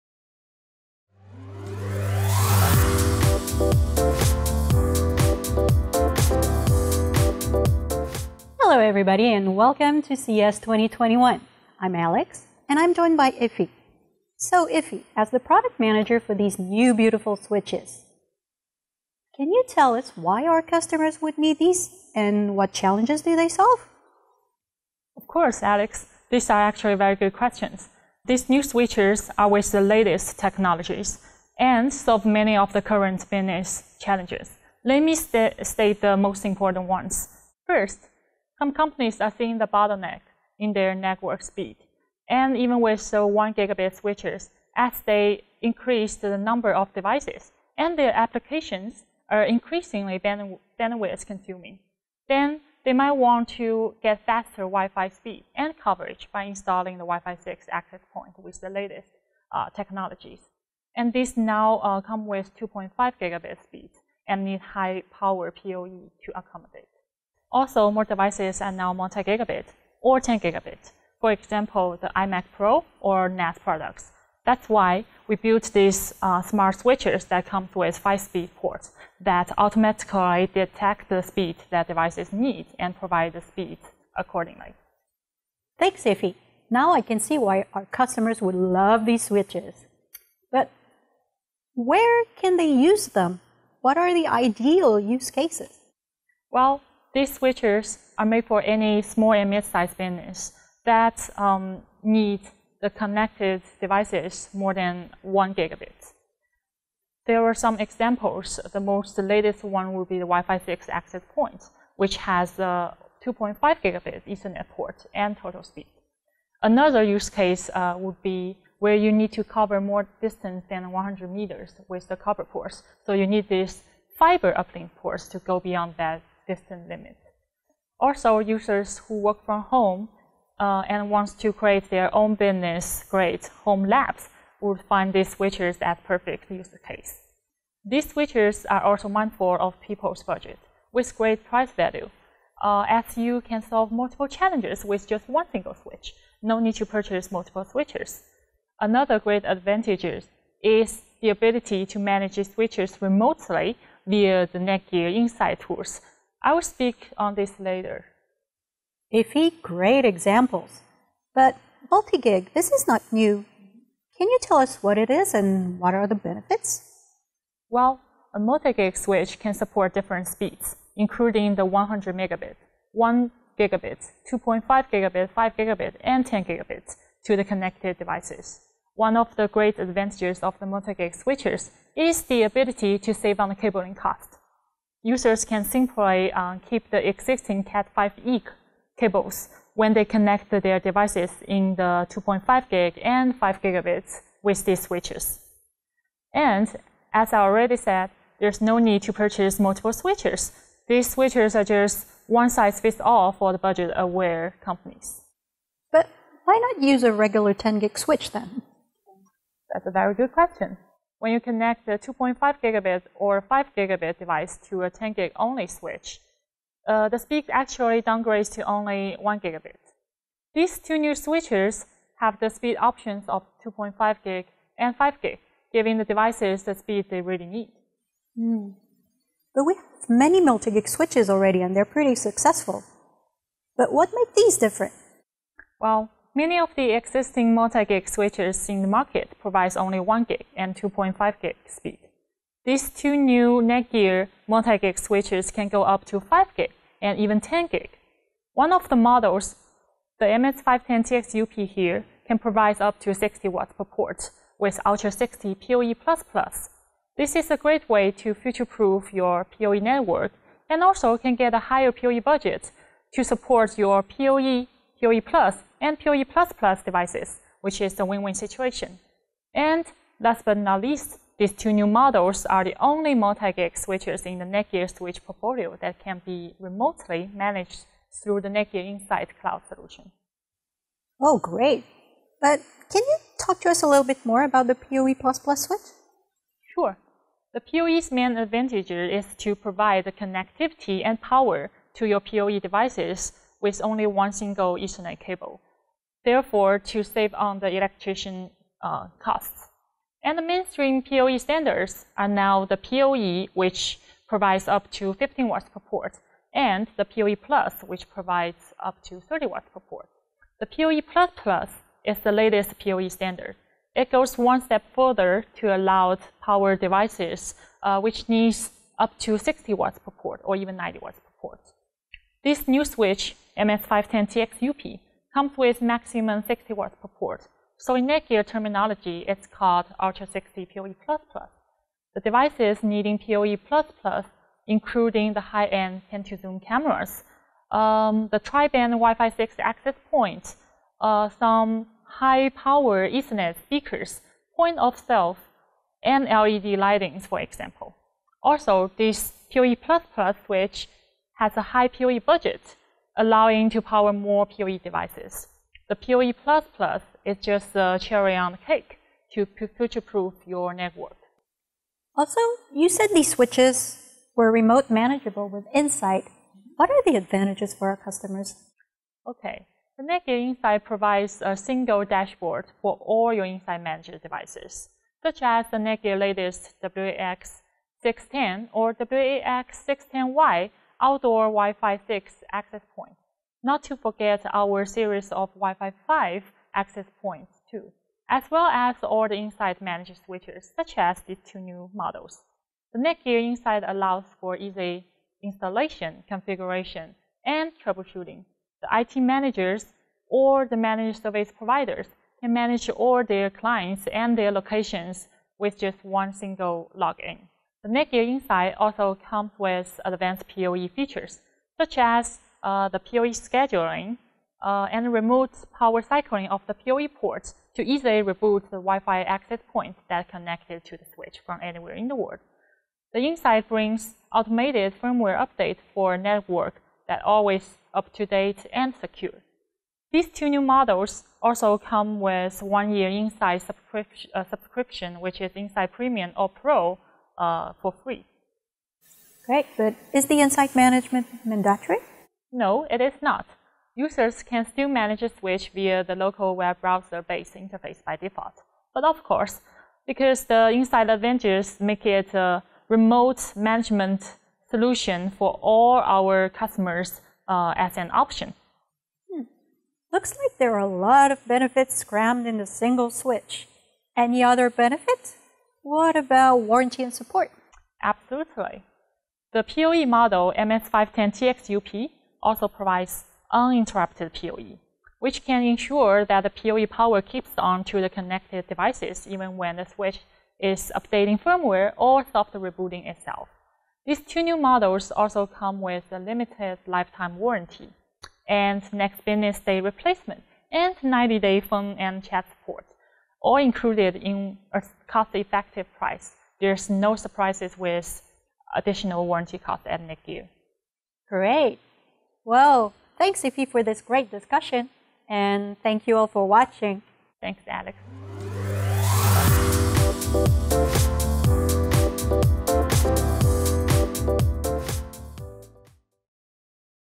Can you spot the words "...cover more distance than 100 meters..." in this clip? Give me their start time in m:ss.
1:59.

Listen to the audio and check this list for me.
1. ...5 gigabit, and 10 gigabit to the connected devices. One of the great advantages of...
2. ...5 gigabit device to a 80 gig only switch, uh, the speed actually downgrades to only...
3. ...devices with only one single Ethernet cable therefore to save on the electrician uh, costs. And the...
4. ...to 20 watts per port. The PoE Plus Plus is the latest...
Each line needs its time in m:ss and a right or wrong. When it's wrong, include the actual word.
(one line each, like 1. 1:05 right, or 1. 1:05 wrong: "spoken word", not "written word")
1. 2:55 right
2. 3:33 wrong: "10", not "80"
3. 4:52 right
4. 5:09 wrong: "30", not "20".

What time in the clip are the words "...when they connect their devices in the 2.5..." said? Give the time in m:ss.
3:09.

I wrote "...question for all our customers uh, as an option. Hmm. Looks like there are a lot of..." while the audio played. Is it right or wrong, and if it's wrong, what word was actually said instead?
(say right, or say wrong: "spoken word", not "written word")
wrong: "solution", not "question".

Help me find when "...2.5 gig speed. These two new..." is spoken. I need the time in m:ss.
4:00.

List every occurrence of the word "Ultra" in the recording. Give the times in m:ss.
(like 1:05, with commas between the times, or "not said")
4:14, 5:29.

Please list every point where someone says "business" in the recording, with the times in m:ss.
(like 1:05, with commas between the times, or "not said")
0:33, 1:39, 2:12, 8:09.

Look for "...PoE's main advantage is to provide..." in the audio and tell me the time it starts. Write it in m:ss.
4:47.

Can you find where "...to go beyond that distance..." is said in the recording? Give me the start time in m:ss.
2:05.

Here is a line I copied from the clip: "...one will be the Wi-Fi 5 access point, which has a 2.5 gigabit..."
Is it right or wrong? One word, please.
wrong.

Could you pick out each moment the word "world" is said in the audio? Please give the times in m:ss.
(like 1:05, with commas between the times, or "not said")
7:02.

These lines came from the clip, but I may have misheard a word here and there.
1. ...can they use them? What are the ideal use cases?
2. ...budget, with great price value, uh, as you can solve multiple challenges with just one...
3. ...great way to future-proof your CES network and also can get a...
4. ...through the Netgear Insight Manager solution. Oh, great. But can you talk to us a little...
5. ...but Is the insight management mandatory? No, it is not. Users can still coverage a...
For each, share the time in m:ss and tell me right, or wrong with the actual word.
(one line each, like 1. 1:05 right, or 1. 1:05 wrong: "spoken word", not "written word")
1. 1:32 right
2. 2:20 right
3. 4:17 wrong: "PoE", not "CES"
4. 4:38 wrong: "Cloud", not "Manager"
5. 7:19 wrong: "manage", not "coverage".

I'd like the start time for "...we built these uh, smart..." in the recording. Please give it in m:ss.
1:15.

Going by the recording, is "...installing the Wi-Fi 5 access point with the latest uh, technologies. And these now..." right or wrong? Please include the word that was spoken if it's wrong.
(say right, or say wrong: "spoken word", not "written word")
wrong: "6", not "5".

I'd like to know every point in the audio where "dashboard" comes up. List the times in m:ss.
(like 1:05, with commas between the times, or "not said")
6:12.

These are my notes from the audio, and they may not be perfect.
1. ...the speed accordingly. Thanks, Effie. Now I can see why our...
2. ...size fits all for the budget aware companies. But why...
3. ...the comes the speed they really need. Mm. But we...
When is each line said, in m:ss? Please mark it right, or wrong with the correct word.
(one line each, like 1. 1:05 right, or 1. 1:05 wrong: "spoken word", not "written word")
1. 1:23 right
2. 3:22 right
3. 3:45 wrong: "devices", not "comes".